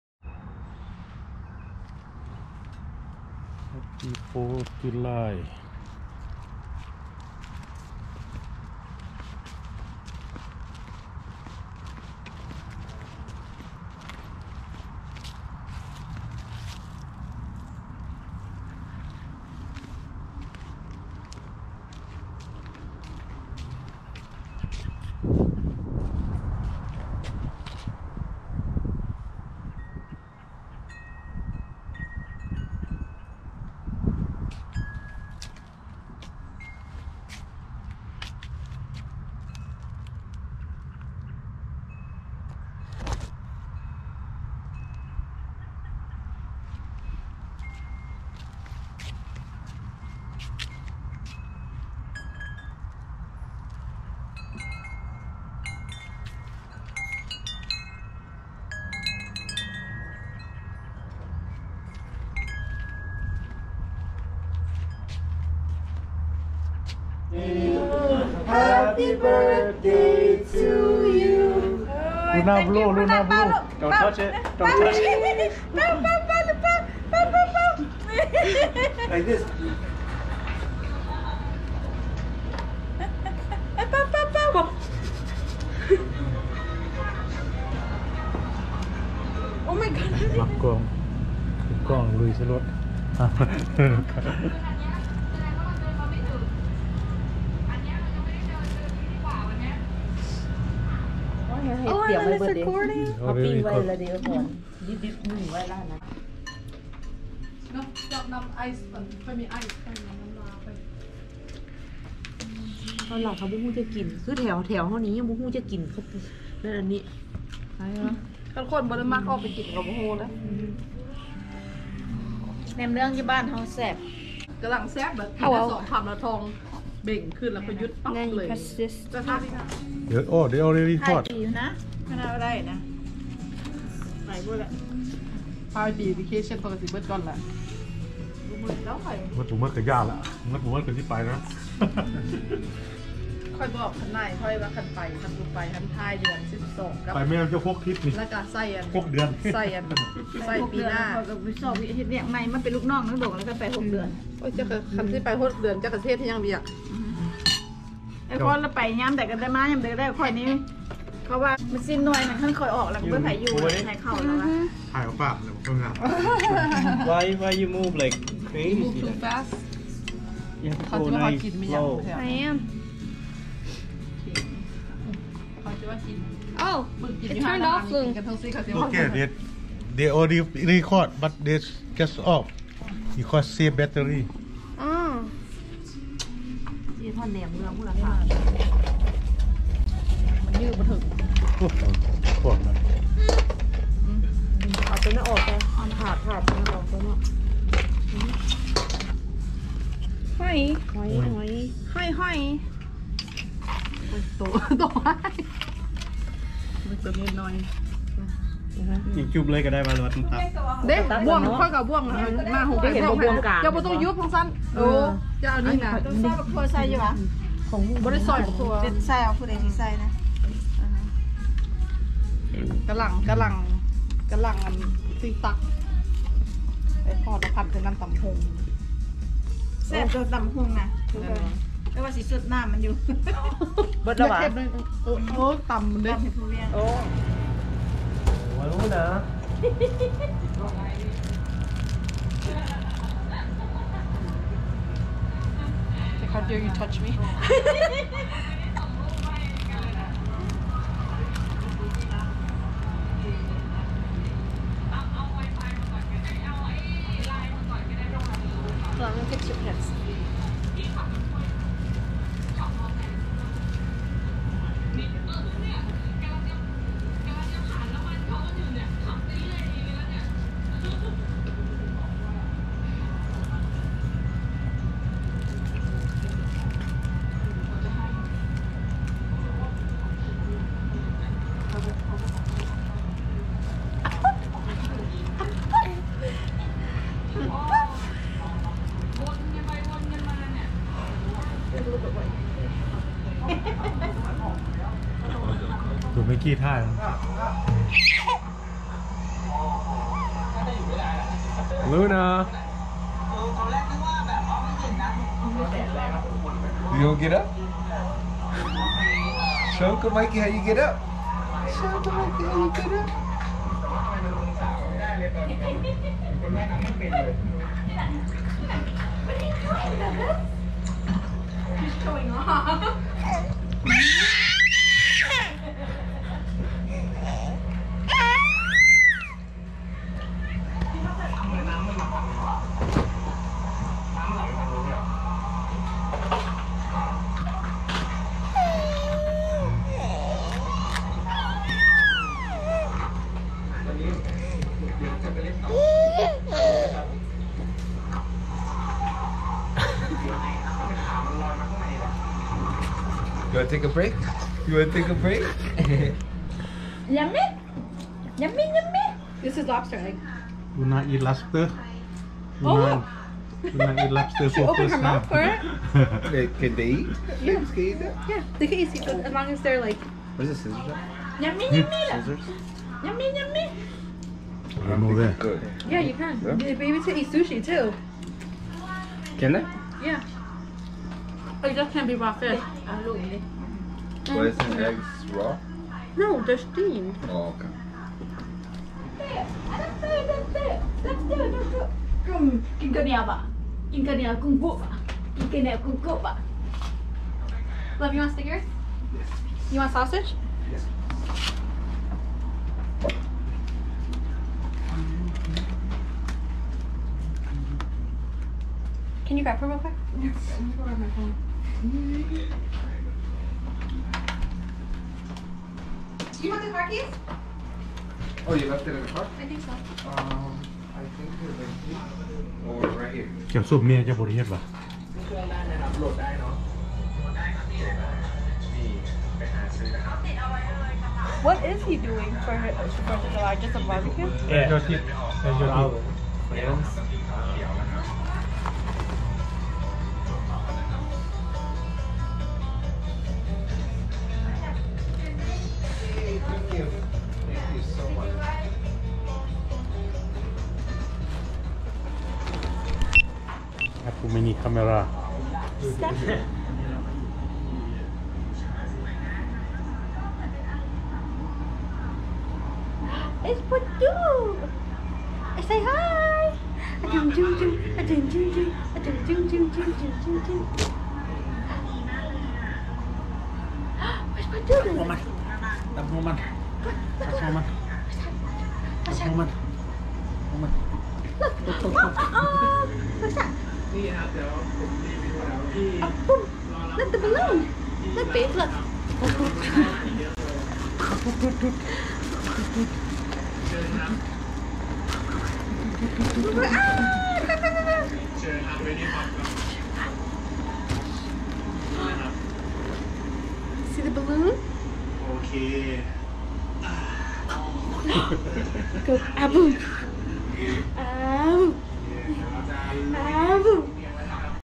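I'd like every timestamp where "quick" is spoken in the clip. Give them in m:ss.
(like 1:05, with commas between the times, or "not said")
6:49.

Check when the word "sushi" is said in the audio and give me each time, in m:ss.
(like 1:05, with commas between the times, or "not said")
6:17.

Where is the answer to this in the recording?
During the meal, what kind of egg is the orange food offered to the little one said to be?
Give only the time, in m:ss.
5:59.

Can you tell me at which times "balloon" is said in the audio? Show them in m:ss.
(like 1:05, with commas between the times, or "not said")
8:07, 8:24.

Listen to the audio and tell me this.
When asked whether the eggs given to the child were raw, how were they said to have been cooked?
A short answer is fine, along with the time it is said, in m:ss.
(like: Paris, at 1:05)
Steamed, at 6:26.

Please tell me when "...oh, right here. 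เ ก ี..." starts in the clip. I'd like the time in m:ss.
7:02.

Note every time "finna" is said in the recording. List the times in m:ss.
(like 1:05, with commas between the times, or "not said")
not said.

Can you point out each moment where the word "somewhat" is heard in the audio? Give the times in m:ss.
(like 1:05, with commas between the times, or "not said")
not said.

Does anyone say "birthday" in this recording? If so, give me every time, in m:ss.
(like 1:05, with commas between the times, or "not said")
1:09.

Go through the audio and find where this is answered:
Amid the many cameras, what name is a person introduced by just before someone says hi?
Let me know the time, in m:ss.
7:43.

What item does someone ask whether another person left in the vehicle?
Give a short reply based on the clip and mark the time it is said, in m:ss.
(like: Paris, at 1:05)
Car keys, at 6:56.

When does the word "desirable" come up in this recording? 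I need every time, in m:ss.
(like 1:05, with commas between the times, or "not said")
not said.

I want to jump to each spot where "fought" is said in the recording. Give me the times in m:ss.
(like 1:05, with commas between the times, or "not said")
not said.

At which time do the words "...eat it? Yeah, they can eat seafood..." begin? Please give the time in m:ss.
6:07.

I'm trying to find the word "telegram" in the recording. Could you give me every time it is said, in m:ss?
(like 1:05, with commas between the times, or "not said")
not said.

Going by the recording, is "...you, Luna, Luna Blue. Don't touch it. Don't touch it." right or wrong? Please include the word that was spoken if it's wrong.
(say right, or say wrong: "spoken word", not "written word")
right.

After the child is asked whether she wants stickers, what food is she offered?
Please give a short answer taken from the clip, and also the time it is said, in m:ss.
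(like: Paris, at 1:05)
Sausage, at 6:39.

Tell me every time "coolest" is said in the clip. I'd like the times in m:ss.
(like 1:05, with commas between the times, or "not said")
not said.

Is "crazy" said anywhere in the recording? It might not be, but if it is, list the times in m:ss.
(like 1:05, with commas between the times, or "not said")
2:48.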